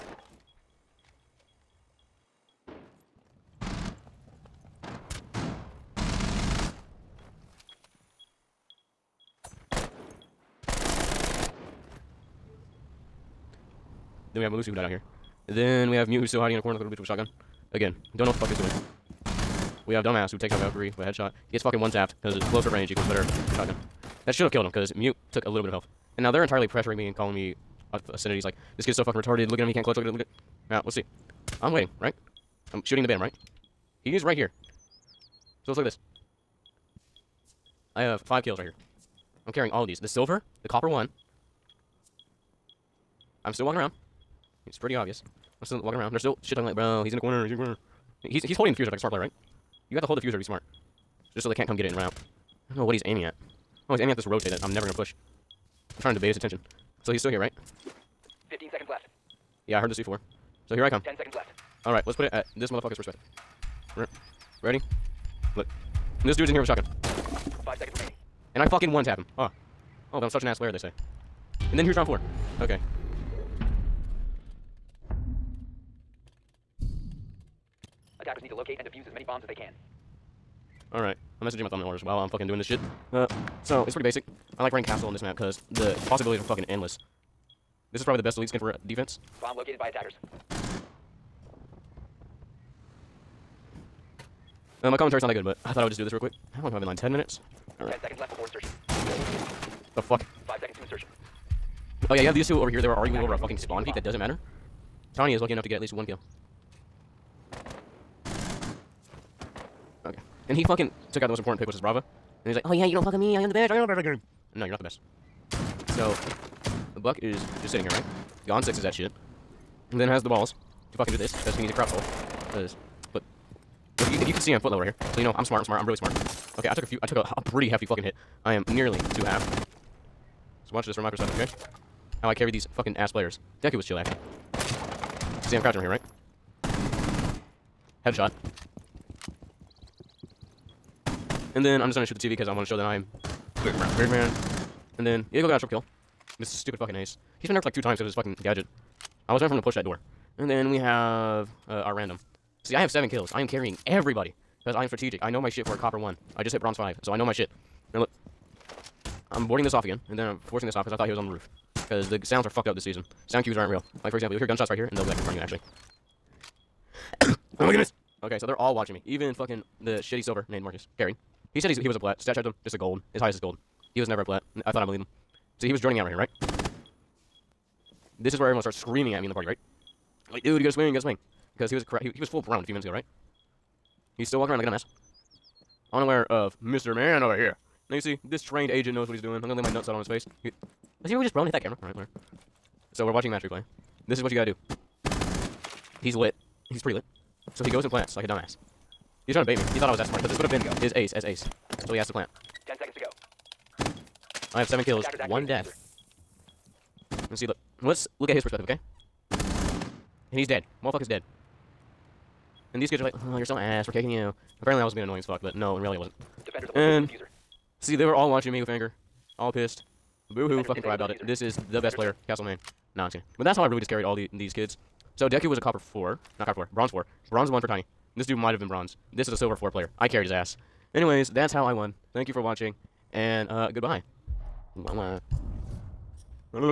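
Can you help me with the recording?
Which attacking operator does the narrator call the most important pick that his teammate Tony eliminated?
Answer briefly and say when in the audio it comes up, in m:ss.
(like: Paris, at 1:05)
Brava, at 1:51.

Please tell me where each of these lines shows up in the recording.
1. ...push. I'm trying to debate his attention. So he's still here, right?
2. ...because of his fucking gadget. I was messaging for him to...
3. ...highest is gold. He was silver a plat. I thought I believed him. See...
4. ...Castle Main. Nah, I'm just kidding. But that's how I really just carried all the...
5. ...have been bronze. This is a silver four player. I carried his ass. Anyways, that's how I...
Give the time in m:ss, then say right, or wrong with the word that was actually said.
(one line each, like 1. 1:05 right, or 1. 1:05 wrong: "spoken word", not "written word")
1. 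0:54 right
2. 2:27 wrong: "waiting", not "messaging"
3. 2:53 wrong: "never", not "silver"
4. 3:42 right
5. 3:48 right.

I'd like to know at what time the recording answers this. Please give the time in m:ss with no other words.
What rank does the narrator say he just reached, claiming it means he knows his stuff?
2:36.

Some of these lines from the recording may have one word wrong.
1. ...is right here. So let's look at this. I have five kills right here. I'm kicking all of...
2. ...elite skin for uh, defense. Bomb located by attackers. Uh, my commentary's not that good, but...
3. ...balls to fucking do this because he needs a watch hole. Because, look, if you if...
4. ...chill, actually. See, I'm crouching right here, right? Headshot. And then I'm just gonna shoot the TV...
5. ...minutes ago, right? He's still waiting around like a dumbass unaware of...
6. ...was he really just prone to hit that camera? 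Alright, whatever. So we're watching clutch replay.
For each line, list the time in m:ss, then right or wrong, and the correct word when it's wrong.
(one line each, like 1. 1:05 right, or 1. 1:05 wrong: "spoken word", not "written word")
1. 0:34 wrong: "carrying", not "kicking"
2. 1:28 right
3. 2:00 wrong: "crouch", not "watch"
4. 2:13 right
5. 3:02 wrong: "walking", not "waiting"
6. 3:11 wrong: "match", not "clutch".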